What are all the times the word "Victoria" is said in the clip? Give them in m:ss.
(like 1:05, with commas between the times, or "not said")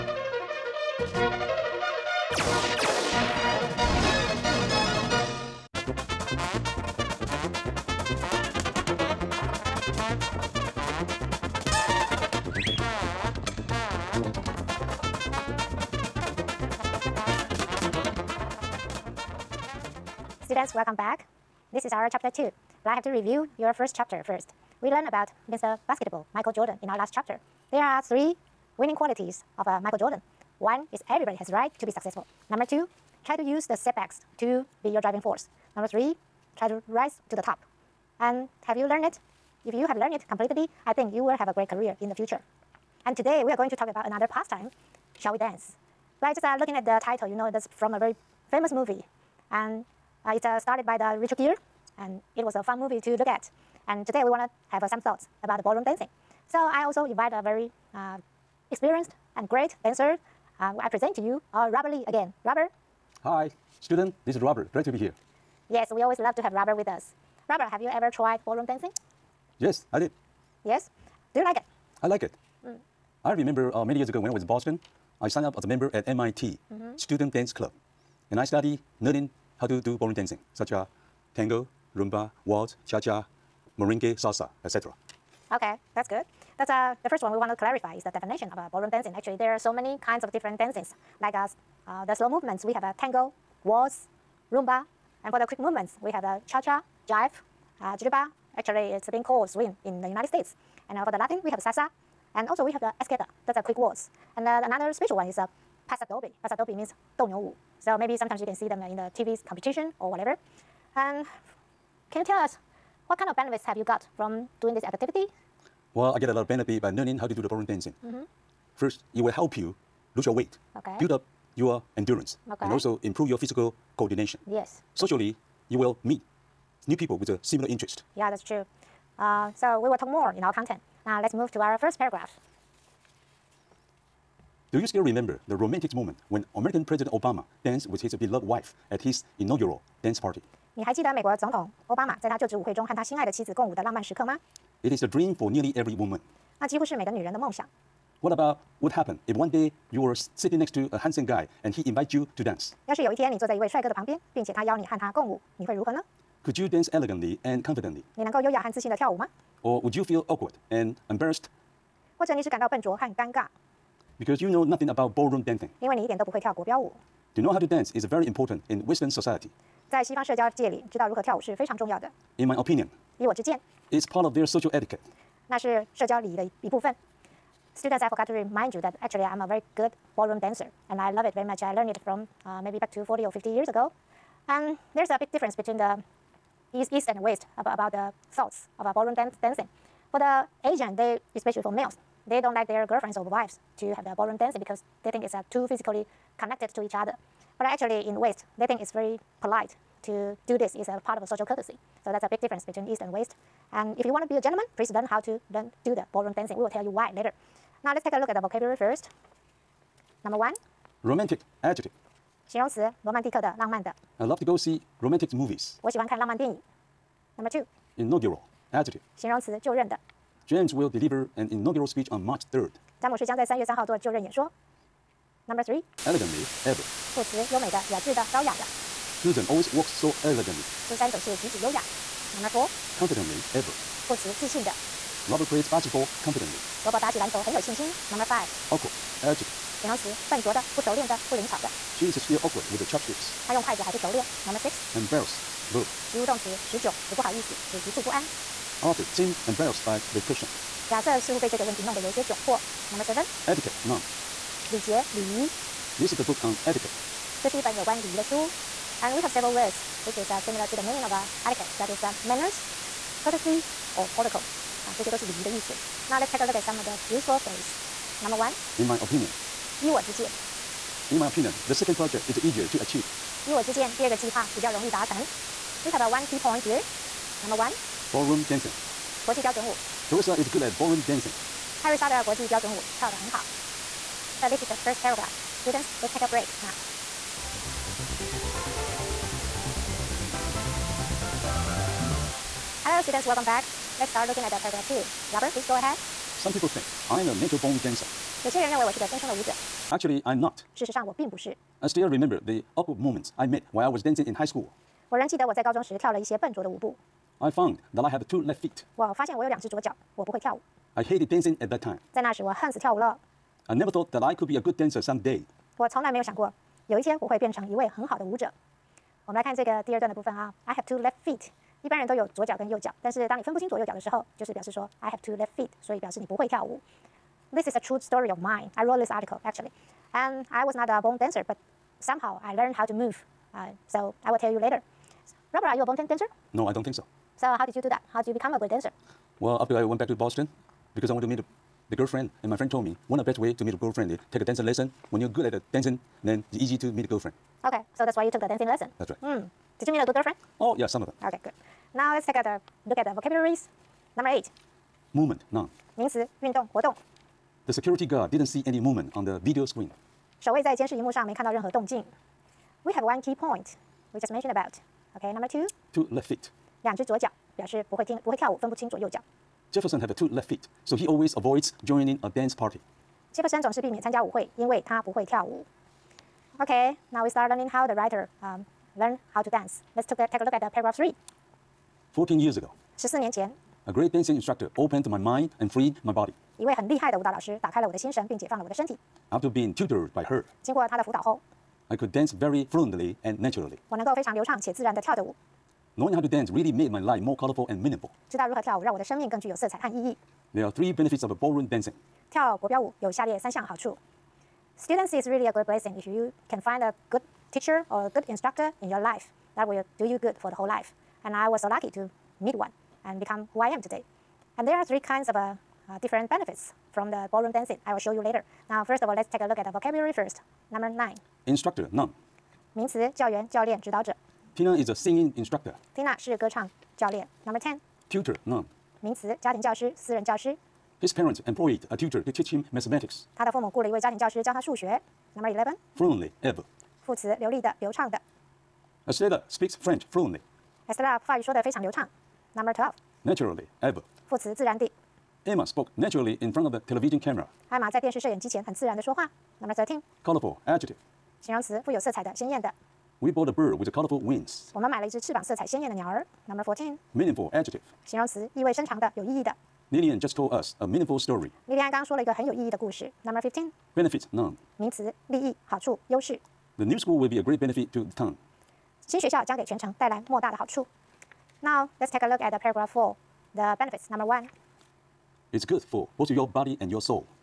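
not said.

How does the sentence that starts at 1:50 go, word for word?
And can you tell us what kind of benefits have you got from doing this activity?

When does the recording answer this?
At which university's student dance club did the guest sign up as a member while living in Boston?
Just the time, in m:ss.
1:16.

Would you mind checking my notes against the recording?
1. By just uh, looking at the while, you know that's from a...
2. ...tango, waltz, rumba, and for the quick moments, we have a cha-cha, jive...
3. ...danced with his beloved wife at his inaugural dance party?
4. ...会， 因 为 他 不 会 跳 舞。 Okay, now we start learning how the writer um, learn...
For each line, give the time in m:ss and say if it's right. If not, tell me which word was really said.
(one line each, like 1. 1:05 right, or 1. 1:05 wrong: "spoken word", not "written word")
1. 0:46 wrong: "title", not "while"
2. 1:32 wrong: "movements", not "moments"
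3. 2:17 right
4. 6:14 right.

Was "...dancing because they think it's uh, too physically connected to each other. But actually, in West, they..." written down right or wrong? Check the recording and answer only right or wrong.
right.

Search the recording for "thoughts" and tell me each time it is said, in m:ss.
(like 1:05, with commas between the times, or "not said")
0:54, 3:08, 5:13.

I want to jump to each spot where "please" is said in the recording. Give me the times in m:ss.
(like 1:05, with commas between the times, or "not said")
3:24, 4:55.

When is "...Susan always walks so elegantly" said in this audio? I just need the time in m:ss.
3:49.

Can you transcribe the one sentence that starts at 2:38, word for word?
你 能 够 优 雅 和 自 信 的 跳 舞 吗 ？Or would you feel awkward?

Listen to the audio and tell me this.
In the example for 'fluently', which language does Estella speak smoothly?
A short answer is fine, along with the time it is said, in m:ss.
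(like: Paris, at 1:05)
French, at 7:19.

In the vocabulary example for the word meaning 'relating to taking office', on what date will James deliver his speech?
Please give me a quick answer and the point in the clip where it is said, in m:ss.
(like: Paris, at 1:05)
March 3rd, at 3:42.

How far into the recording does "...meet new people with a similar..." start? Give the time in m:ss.
2:06.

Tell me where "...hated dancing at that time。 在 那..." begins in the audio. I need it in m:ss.
5:11.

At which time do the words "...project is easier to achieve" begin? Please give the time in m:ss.
4:31.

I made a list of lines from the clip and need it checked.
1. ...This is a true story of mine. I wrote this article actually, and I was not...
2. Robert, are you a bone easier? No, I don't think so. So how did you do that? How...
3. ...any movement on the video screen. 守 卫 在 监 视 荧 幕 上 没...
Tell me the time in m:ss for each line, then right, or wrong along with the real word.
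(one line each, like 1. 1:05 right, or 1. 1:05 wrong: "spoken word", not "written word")
1. 5:27 right
2. 5:35 wrong: "dancer", not "easier"
3. 5:58 right.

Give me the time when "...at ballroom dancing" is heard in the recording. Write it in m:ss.
4:40.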